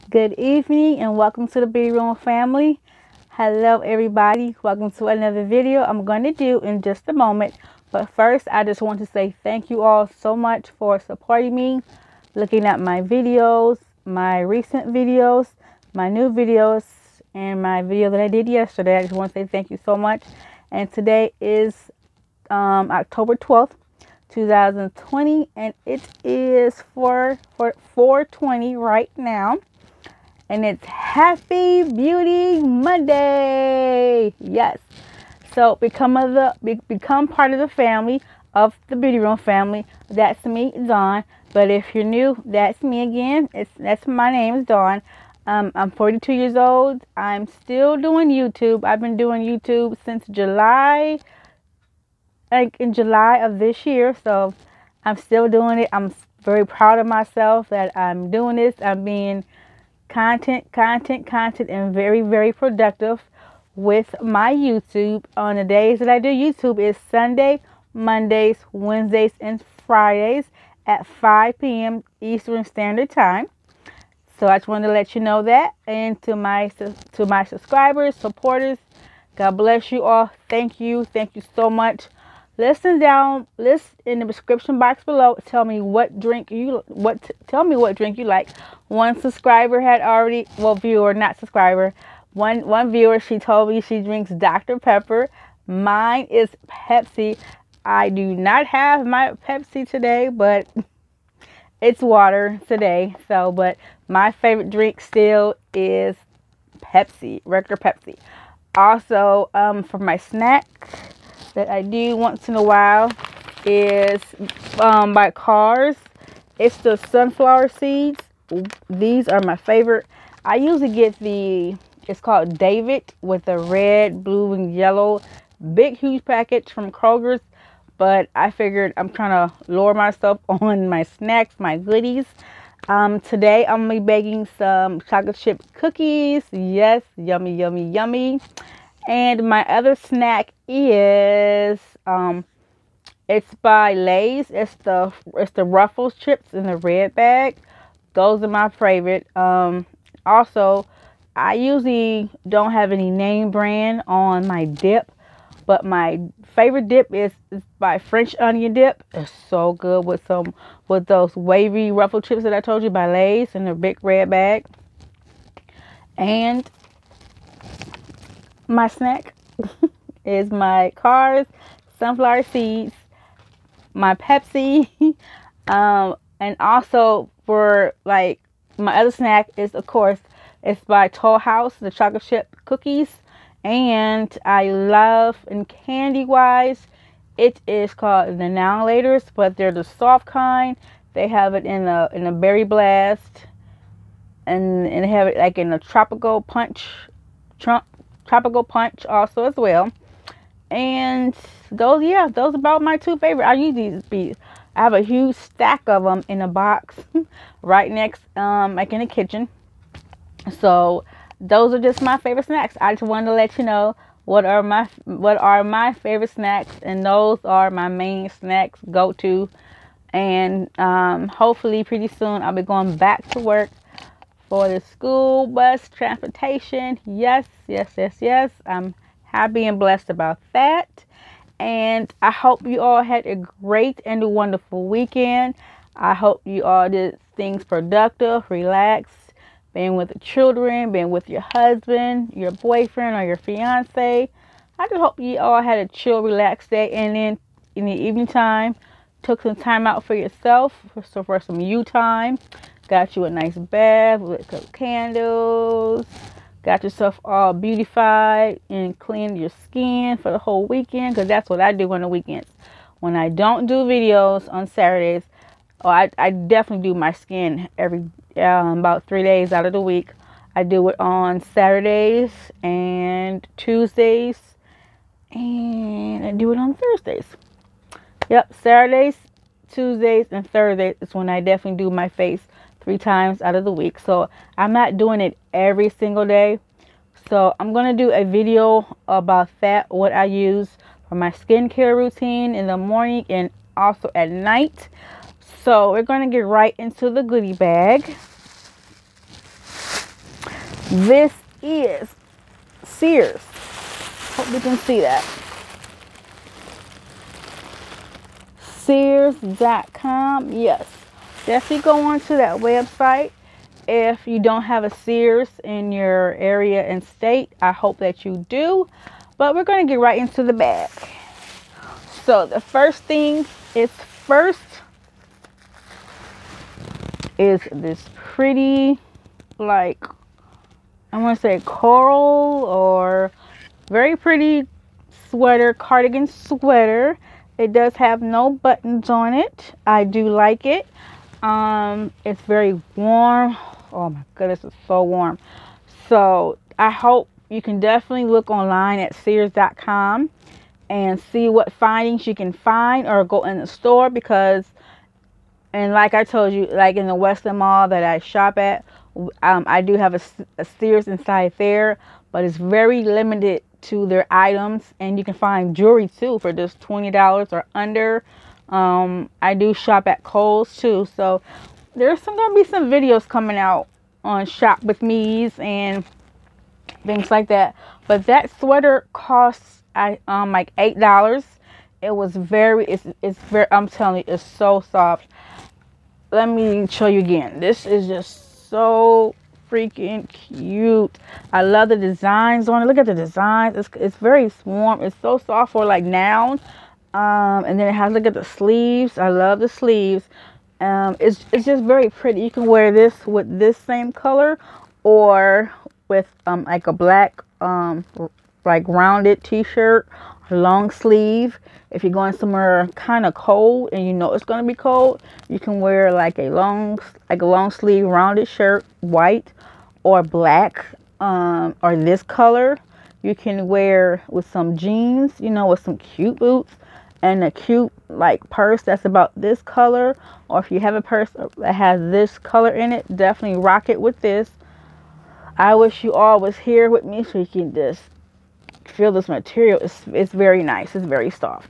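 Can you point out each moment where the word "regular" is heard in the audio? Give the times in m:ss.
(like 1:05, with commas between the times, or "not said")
1:47.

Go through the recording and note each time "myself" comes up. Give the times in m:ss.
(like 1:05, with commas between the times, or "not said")
0:57, 2:09.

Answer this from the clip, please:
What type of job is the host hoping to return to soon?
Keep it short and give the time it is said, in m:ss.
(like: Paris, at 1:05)
school bus transportation, at 3:44.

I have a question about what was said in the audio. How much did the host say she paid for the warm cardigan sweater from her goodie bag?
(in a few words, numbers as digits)
$8.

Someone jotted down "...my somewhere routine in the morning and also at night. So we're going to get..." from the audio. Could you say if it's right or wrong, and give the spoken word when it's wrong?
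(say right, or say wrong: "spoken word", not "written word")
wrong: "skincare", not "somewhere".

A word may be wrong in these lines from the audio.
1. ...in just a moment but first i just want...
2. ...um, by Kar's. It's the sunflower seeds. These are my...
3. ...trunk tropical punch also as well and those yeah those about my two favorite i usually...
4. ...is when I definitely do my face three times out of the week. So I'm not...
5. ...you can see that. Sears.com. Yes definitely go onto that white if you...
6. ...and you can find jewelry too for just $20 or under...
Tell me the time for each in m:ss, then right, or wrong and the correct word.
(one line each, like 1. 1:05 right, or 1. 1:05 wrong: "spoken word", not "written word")
1. 0:06 right
2. 1:54 right
3. 3:17 right
4. 4:41 right
5. 5:04 wrong: "website", not "white"
6. 6:05 right.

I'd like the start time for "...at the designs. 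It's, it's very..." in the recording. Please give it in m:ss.
6:32.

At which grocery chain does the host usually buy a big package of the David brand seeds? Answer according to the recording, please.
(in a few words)
Kroger's.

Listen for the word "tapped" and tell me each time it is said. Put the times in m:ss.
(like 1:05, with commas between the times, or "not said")
not said.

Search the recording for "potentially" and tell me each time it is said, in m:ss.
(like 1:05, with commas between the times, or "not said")
not said.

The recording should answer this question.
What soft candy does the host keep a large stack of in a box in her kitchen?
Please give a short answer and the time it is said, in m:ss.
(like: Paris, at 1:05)
Now and Laters, at 3:08.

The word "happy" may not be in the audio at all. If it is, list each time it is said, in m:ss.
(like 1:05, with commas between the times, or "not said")
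0:30, 3:49.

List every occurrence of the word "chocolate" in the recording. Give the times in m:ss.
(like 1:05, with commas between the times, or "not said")
2:15, 3:01.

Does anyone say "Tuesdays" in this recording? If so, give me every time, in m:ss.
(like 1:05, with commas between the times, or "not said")
4:33, 4:39.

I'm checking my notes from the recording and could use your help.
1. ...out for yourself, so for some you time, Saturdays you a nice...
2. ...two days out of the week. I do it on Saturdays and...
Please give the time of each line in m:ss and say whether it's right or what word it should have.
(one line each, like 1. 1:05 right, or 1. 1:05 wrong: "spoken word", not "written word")
1. 4:09 wrong: "Got", not "Saturdays"
2. 4:29 wrong: "three", not "two".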